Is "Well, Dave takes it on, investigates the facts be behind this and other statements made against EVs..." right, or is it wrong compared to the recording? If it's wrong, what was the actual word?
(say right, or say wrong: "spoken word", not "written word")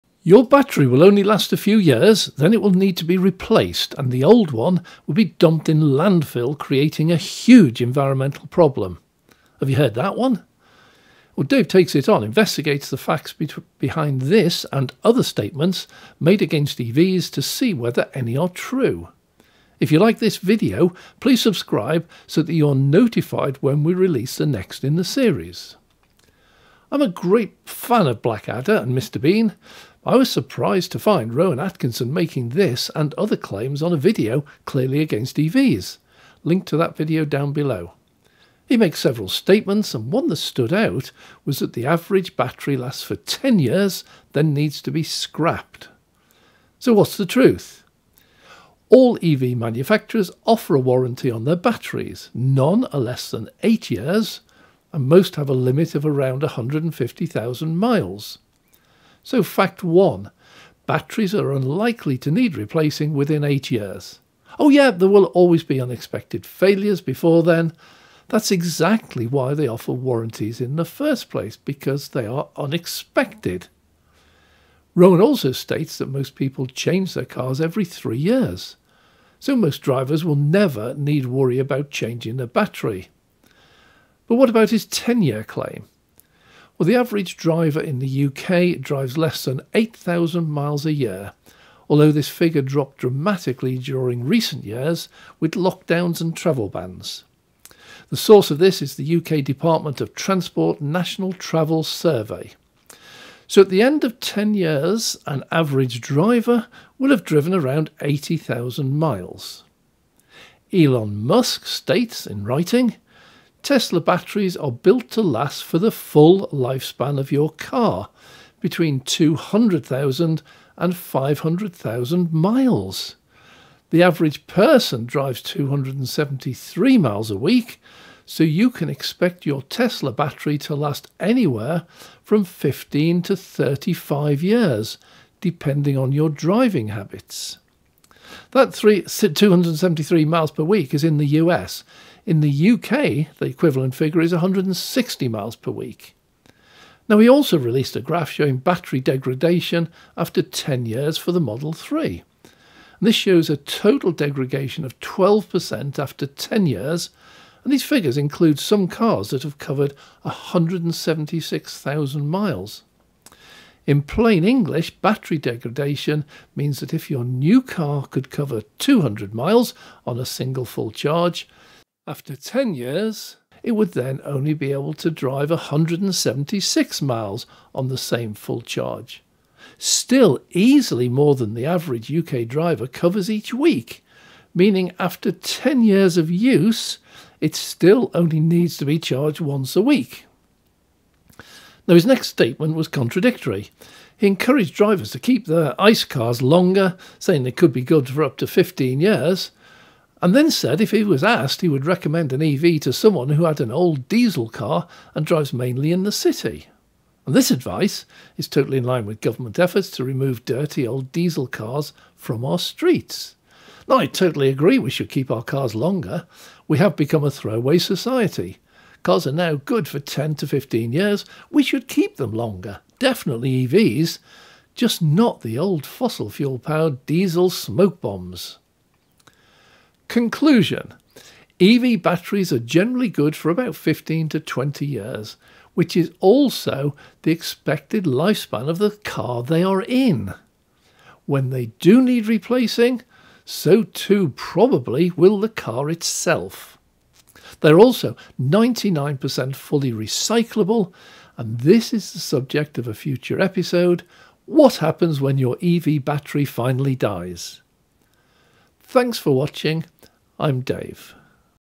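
right.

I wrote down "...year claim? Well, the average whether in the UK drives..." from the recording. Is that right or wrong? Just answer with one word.
wrong.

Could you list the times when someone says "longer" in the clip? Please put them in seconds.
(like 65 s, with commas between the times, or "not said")
196 s, 215 s, 222 s.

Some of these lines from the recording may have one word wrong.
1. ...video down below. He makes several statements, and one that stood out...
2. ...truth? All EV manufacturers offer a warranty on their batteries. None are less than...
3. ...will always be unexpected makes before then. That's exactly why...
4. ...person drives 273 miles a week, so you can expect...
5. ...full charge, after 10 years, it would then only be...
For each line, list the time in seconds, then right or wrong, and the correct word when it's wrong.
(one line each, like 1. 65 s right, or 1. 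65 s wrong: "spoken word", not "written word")
1. 36 s right
2. 47 s right
3. 65 s wrong: "failures", not "makes"
4. 124 s right
5. 170 s right.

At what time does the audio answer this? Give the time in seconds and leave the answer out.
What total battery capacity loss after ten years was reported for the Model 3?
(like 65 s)
154 s.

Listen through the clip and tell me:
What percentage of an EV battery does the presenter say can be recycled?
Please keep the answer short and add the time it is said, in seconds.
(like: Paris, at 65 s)
99%, at 248 s.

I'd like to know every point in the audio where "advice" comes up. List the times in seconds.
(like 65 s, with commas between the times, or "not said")
207 s.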